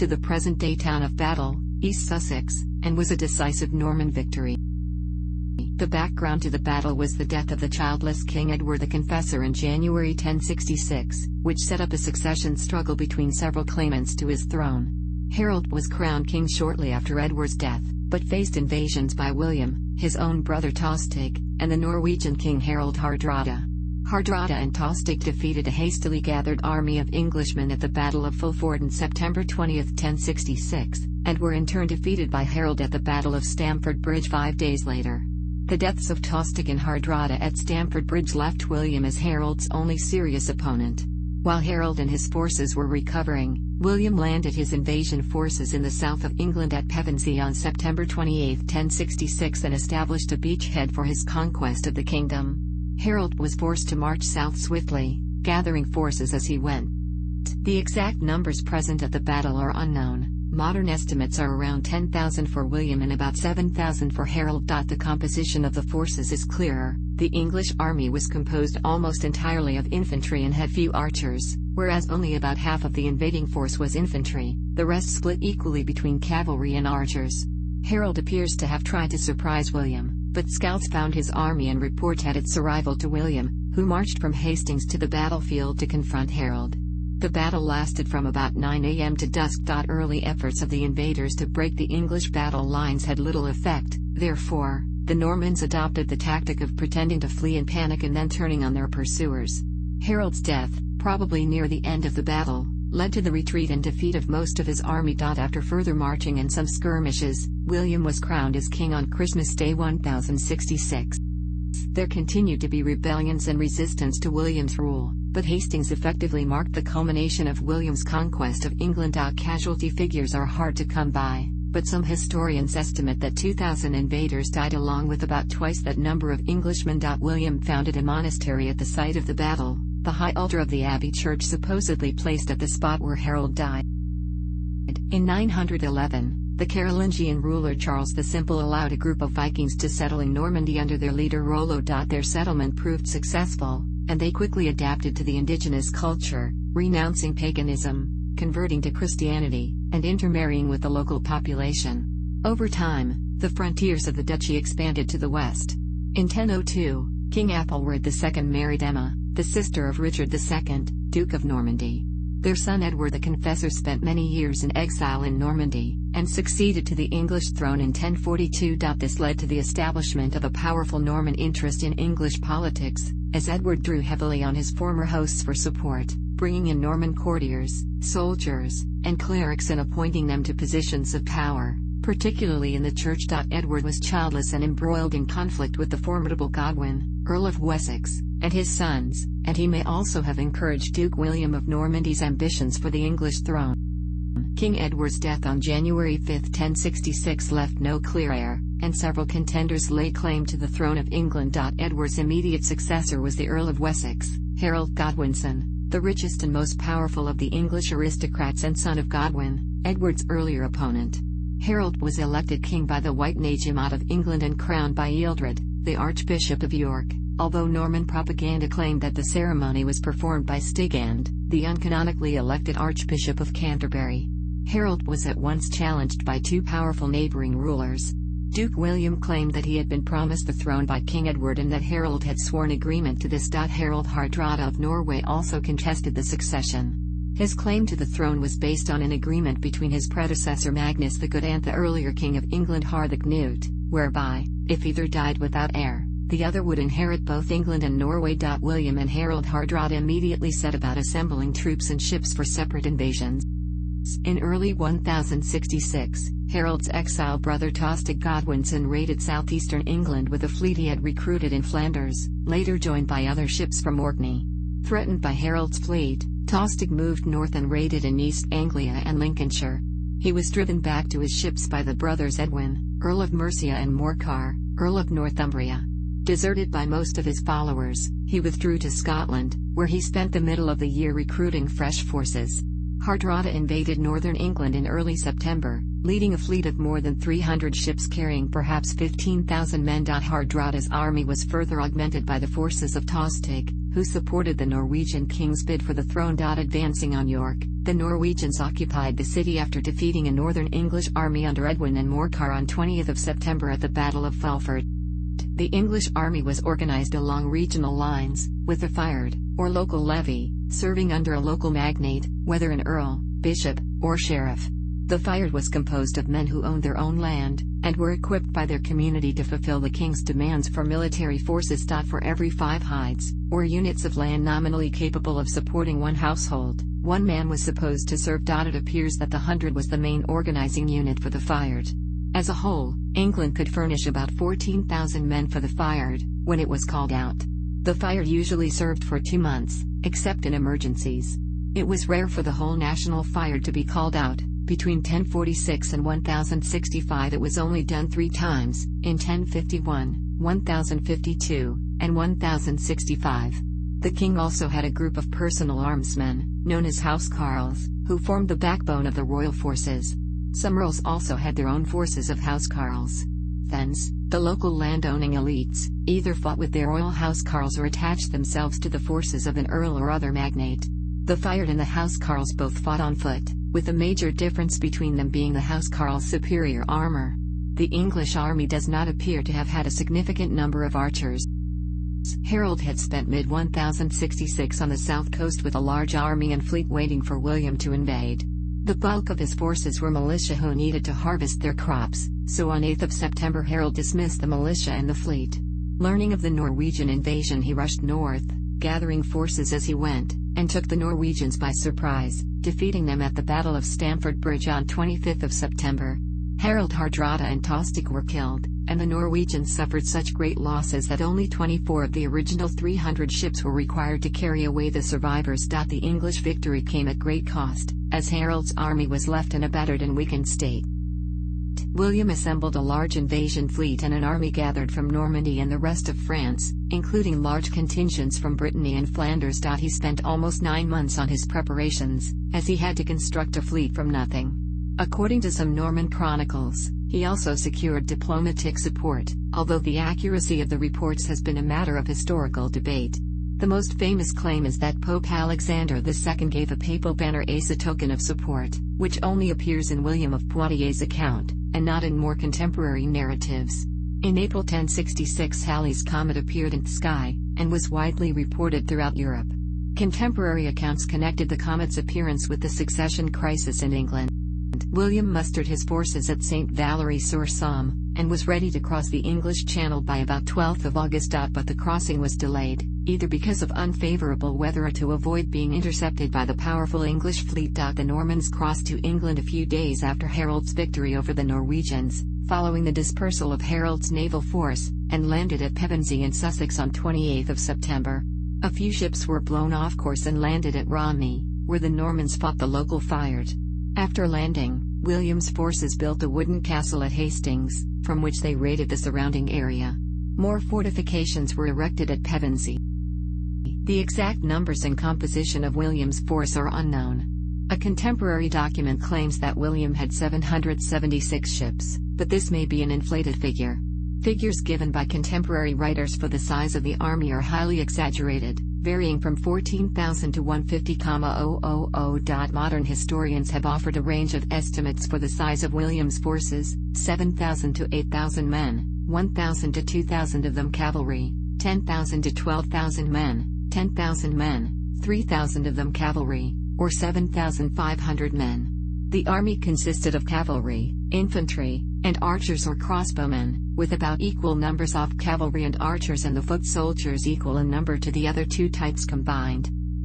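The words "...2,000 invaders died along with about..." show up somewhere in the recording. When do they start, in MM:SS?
02:03.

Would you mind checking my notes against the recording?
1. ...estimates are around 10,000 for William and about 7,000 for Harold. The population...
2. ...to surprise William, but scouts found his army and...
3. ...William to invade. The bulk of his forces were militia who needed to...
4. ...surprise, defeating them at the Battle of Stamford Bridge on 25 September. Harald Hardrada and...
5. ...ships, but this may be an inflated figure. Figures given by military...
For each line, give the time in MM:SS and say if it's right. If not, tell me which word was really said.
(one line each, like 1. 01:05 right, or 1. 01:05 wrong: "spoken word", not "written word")
1. 01:00 wrong: "composition", not "population"
2. 01:19 right
3. 06:27 right
4. 06:41 right
5. 08:31 wrong: "contemporary", not "military".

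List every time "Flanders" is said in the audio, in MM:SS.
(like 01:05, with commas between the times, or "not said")
04:21, 07:09.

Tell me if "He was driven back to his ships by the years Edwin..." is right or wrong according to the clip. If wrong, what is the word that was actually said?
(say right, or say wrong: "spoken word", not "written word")
wrong: "brothers", not "years".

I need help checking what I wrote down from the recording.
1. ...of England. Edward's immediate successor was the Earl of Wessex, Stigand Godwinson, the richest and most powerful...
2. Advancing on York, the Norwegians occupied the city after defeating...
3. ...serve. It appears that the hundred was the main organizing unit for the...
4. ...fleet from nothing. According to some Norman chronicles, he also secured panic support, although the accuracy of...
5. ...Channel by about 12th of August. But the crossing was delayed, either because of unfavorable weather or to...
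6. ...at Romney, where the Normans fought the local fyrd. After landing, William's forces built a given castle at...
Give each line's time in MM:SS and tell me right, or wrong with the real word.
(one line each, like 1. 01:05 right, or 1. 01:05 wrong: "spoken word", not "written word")
1. 03:20 wrong: "Harold", not "Stigand"
2. 04:56 right
3. 05:28 right
4. 07:13 wrong: "diplomatic", not "panic"
5. 07:49 right
6. 08:10 wrong: "wooden", not "given".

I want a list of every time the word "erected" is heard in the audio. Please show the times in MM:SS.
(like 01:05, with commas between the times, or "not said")
08:21.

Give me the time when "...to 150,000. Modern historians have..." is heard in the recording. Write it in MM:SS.
08:40.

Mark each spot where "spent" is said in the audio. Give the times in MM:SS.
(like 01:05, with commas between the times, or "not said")
02:43, 04:40, 06:22, 07:09.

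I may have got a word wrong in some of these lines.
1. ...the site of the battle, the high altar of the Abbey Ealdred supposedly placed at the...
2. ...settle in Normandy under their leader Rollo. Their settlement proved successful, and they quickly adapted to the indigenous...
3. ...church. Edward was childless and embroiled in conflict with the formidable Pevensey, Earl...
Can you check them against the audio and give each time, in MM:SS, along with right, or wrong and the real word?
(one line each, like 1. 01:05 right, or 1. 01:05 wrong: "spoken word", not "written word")
1. 02:08 wrong: "Church", not "Ealdred"
2. 02:19 right
3. 03:02 wrong: "Godwin", not "Pevensey".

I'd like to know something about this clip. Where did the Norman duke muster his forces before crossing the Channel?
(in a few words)
St. Valery sur Somme.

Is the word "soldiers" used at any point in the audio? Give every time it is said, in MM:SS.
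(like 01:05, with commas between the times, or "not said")
02:58, 09:06.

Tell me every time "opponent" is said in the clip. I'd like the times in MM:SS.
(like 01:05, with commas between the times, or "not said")
00:40, 03:30.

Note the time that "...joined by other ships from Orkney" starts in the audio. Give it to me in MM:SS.
04:22.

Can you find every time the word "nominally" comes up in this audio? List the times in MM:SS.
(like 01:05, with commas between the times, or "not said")
05:24.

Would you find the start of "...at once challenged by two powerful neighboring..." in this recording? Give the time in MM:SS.
03:45.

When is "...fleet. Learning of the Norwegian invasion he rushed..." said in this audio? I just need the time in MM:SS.
06:35.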